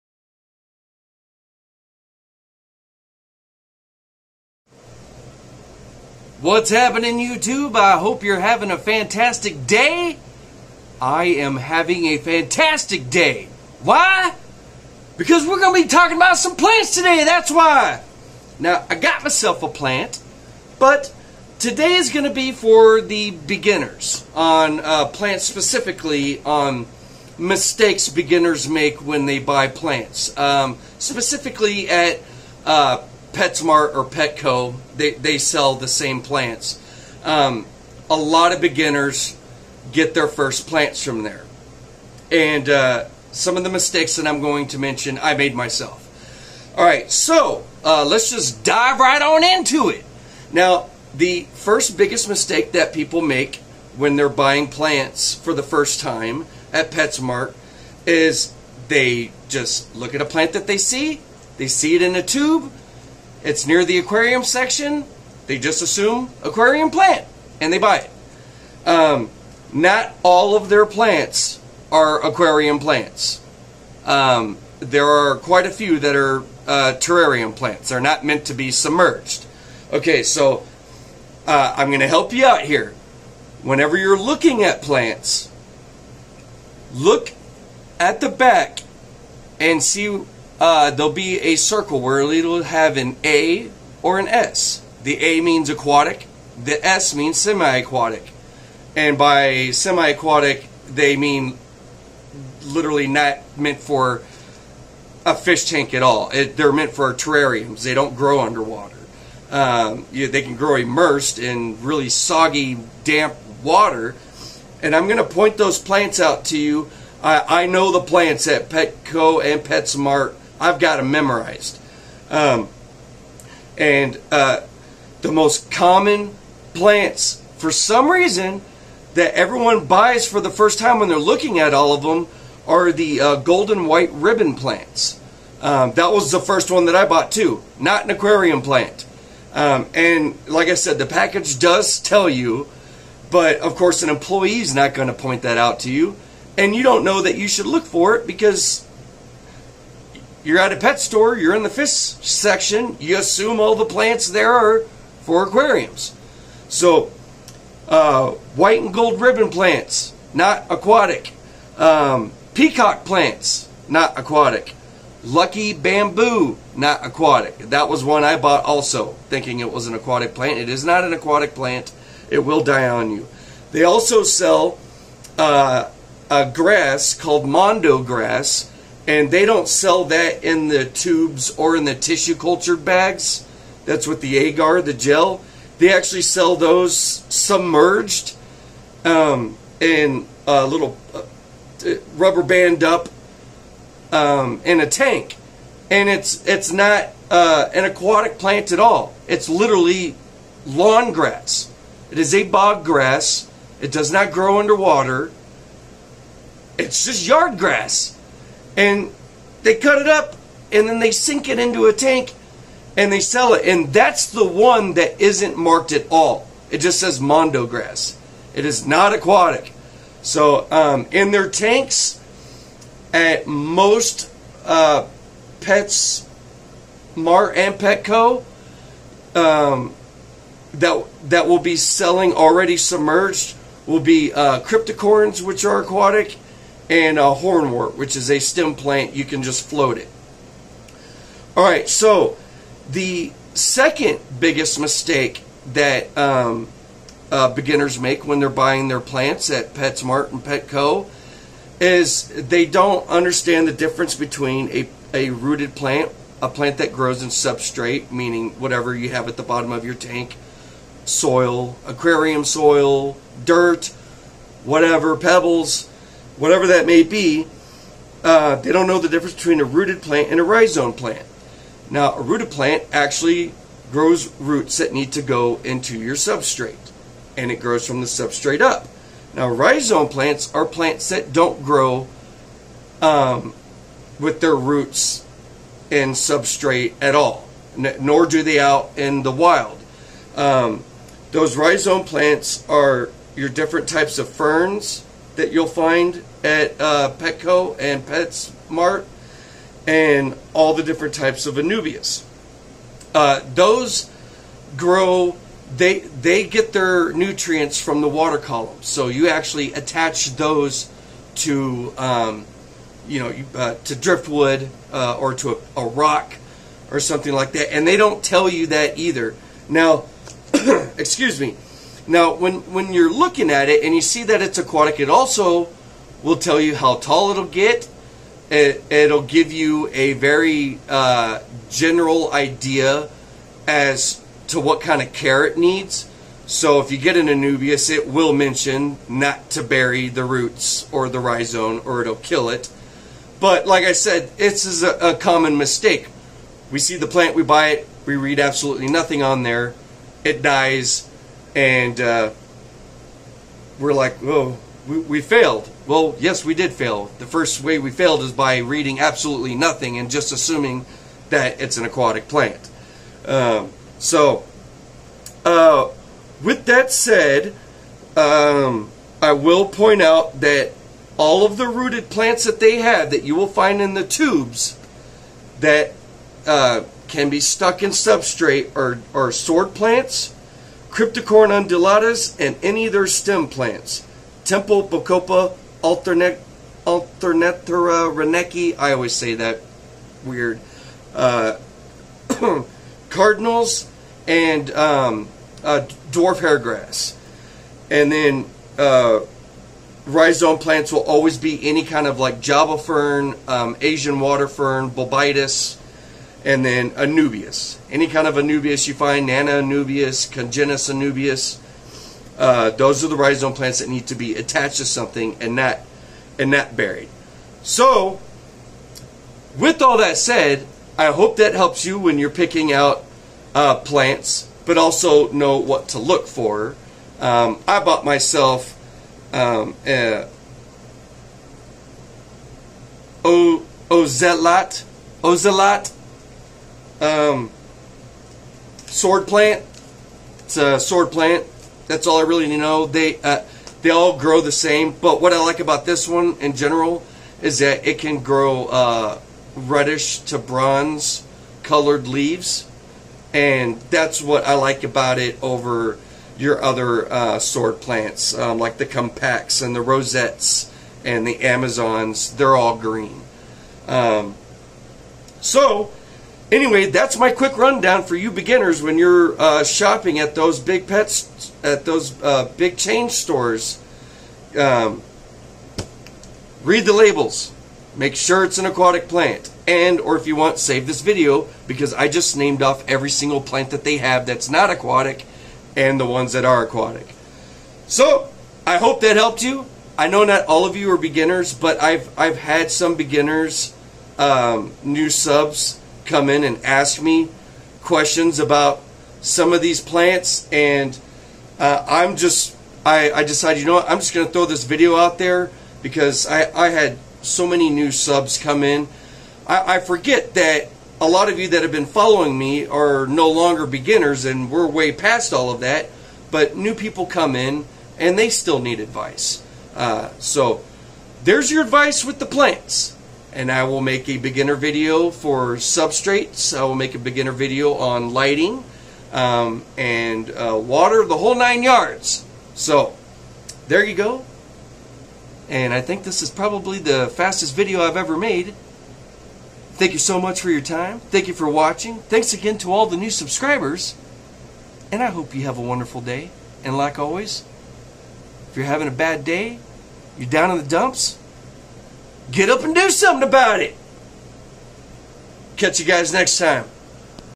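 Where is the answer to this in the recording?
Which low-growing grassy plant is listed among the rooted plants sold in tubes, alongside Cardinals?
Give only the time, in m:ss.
6:36.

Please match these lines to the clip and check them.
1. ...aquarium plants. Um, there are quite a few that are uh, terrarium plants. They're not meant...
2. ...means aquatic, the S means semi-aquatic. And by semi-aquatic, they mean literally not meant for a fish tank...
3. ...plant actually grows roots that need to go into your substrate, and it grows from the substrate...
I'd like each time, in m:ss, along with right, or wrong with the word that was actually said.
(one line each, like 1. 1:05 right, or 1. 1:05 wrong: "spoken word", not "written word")
1. 1:12 right
2. 1:35 right
3. 4:32 right.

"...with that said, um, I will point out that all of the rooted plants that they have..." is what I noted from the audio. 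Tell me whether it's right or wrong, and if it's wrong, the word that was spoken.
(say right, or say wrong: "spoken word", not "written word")
right.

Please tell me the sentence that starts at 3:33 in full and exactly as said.
And that's the one that isn't marked at all.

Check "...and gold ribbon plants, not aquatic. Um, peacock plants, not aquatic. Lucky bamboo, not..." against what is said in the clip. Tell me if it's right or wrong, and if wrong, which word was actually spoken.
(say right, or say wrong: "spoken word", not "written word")
right.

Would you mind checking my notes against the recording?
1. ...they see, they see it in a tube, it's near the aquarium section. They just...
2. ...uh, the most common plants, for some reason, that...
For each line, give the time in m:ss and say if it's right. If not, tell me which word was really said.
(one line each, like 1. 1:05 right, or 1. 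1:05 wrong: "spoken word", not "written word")
1. 1:00 right
2. 2:04 right.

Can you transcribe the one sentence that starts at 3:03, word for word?
That's what the agar, the gel.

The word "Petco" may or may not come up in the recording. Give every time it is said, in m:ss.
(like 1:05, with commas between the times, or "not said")
0:34, 1:58, 3:47, 4:10, 4:57.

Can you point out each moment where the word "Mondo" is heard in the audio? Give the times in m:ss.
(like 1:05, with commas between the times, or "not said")
2:57, 3:37.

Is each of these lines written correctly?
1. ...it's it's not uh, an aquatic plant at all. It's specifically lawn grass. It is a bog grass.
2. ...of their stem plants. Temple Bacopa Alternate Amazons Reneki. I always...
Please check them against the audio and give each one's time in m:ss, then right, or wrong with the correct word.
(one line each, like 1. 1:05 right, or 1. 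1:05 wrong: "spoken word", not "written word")
1. 3:16 wrong: "literally", not "specifically"
2. 6:22 wrong: "Alternatera", not "Amazons".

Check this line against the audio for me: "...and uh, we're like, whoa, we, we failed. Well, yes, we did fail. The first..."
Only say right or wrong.
right.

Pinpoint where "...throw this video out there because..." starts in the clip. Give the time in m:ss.
8:24.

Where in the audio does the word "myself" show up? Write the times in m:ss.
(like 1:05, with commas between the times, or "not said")
0:19, 0:45, 7:08.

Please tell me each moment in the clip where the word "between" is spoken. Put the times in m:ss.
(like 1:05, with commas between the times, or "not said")
4:14, 4:29.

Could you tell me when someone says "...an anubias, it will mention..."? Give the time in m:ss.
5:37.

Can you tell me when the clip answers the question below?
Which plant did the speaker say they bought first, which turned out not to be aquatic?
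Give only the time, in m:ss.
2:13.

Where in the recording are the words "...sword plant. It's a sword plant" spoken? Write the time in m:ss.
7:18.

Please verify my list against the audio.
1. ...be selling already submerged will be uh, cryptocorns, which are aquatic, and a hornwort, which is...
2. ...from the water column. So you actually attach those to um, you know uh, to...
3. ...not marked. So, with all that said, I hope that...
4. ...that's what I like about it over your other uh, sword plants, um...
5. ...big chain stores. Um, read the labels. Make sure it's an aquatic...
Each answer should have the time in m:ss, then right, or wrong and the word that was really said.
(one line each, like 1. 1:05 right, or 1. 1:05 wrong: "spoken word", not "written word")
1. 3:51 right
2. 5:07 right
3. 6:56 wrong: "buried", not "marked"
4. 7:33 right
5. 7:52 right.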